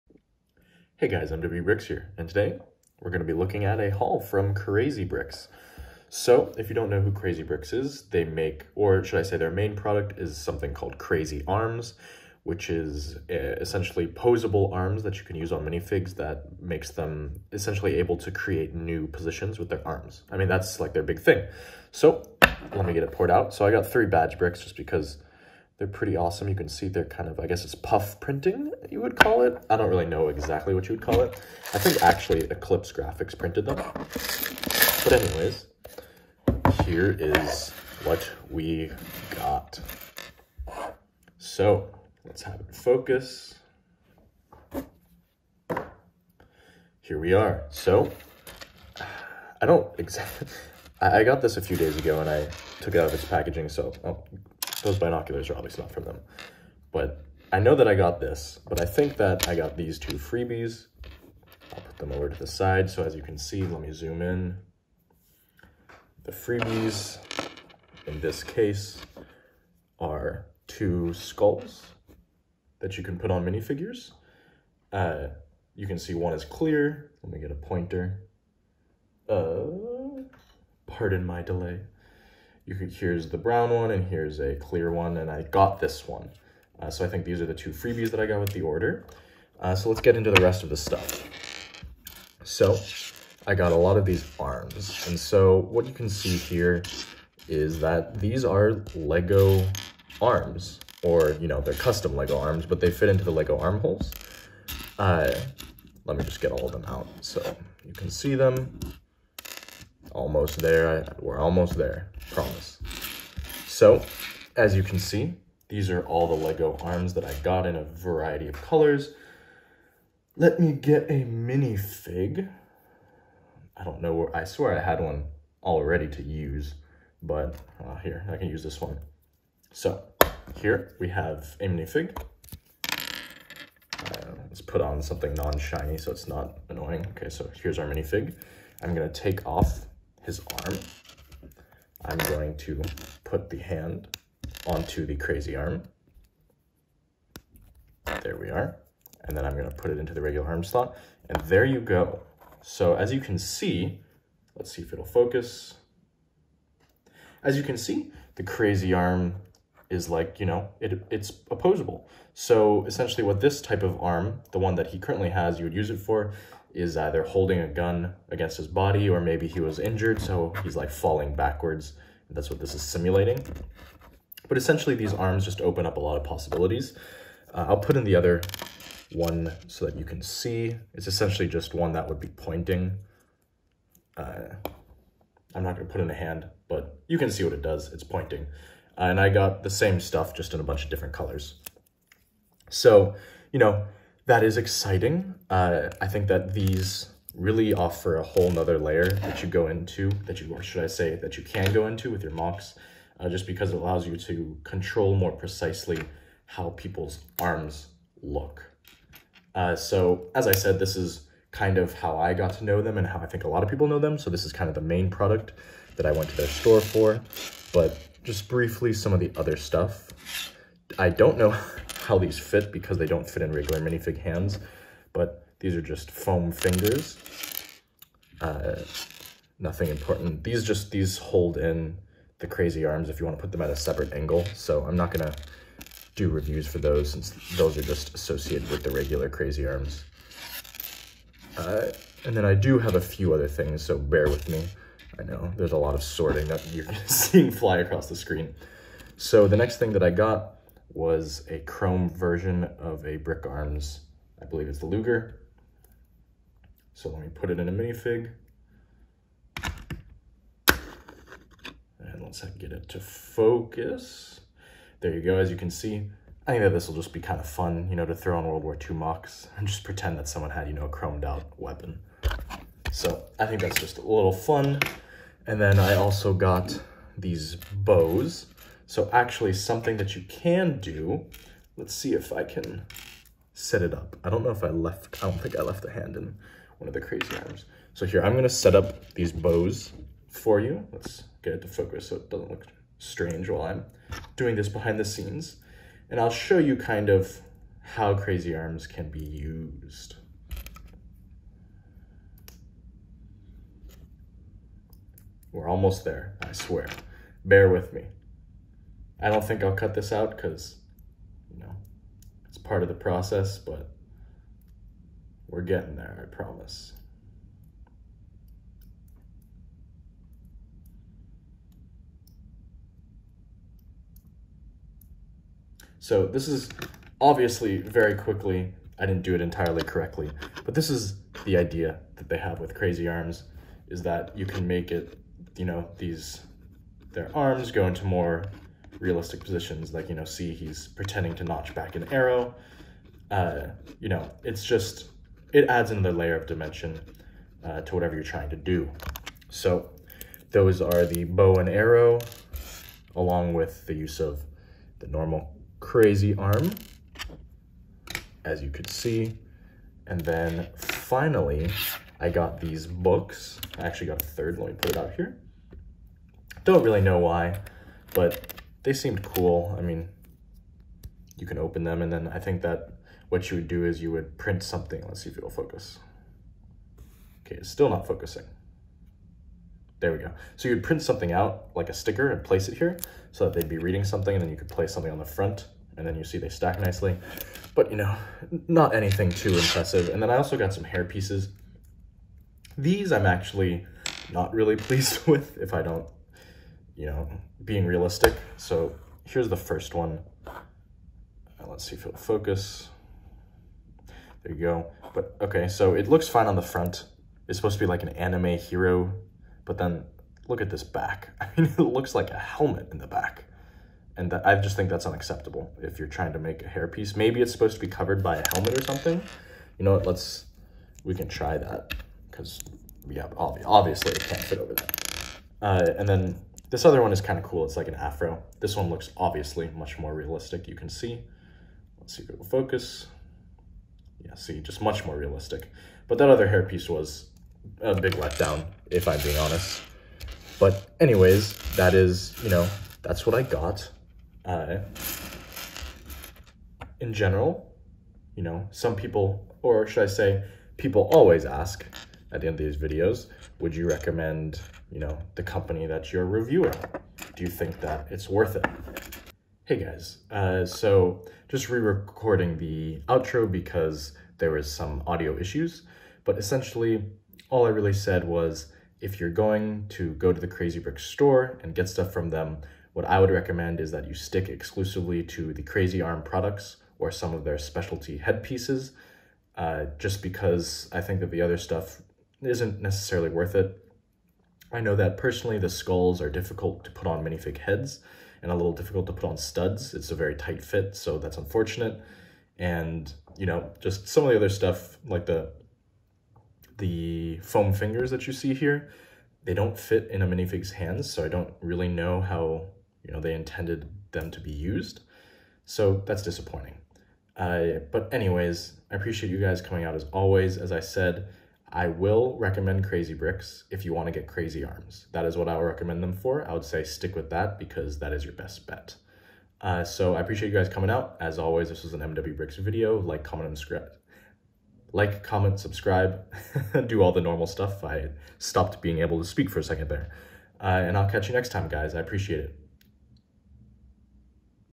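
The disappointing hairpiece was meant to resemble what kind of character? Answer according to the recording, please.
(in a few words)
anime hero.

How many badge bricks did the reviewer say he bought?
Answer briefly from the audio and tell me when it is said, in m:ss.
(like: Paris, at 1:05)
3, at 0:23.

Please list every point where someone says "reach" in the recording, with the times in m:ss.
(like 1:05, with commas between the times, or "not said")
not said.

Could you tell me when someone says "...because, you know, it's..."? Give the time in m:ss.
5:10.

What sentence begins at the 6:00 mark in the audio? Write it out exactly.
And then finally, I got these books.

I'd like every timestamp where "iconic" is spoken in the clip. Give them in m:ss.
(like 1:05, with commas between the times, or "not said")
not said.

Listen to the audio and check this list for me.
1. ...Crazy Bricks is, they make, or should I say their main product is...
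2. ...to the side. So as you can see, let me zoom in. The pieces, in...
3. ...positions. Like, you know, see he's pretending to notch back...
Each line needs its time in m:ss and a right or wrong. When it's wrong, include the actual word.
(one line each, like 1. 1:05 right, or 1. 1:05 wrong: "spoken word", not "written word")
1. 0:07 right
2. 1:02 wrong: "freebies", not "pieces"
3. 5:39 right.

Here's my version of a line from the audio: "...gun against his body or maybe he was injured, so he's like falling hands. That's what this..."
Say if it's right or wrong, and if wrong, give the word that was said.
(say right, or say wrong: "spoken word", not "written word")
wrong: "backwards", not "hands".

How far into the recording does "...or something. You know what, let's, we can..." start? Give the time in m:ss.
6:58.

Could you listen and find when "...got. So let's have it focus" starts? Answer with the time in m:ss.
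0:39.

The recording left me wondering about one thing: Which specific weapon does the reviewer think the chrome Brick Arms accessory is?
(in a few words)
Luger.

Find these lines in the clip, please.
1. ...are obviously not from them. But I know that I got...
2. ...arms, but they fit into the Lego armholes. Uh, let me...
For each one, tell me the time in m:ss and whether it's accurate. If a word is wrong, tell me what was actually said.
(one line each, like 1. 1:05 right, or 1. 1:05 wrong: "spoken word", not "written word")
1. 0:55 right
2. 1:42 right.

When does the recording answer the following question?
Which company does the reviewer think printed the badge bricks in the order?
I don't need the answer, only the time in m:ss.
0:32.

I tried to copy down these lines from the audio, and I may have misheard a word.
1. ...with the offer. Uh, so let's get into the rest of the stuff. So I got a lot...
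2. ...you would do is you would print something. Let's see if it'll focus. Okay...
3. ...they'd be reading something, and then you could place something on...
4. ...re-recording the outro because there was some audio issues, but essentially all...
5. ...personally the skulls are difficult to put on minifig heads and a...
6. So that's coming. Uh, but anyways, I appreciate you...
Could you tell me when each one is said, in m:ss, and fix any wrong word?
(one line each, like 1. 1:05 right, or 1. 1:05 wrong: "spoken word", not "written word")
1. 1:28 wrong: "order", not "offer"
2. 6:13 right
3. 6:23 right
4. 7:41 right
5. 8:05 right
6. 8:25 wrong: "disappointing", not "coming".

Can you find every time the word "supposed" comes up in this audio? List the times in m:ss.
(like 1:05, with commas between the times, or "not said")
6:47, 6:57.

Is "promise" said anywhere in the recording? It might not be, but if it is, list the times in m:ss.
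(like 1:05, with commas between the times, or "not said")
1:52, 5:16.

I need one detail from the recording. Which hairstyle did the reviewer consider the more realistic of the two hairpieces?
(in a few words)
afro.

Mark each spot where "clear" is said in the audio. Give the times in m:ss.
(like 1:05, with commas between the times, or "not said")
1:16, 1:24.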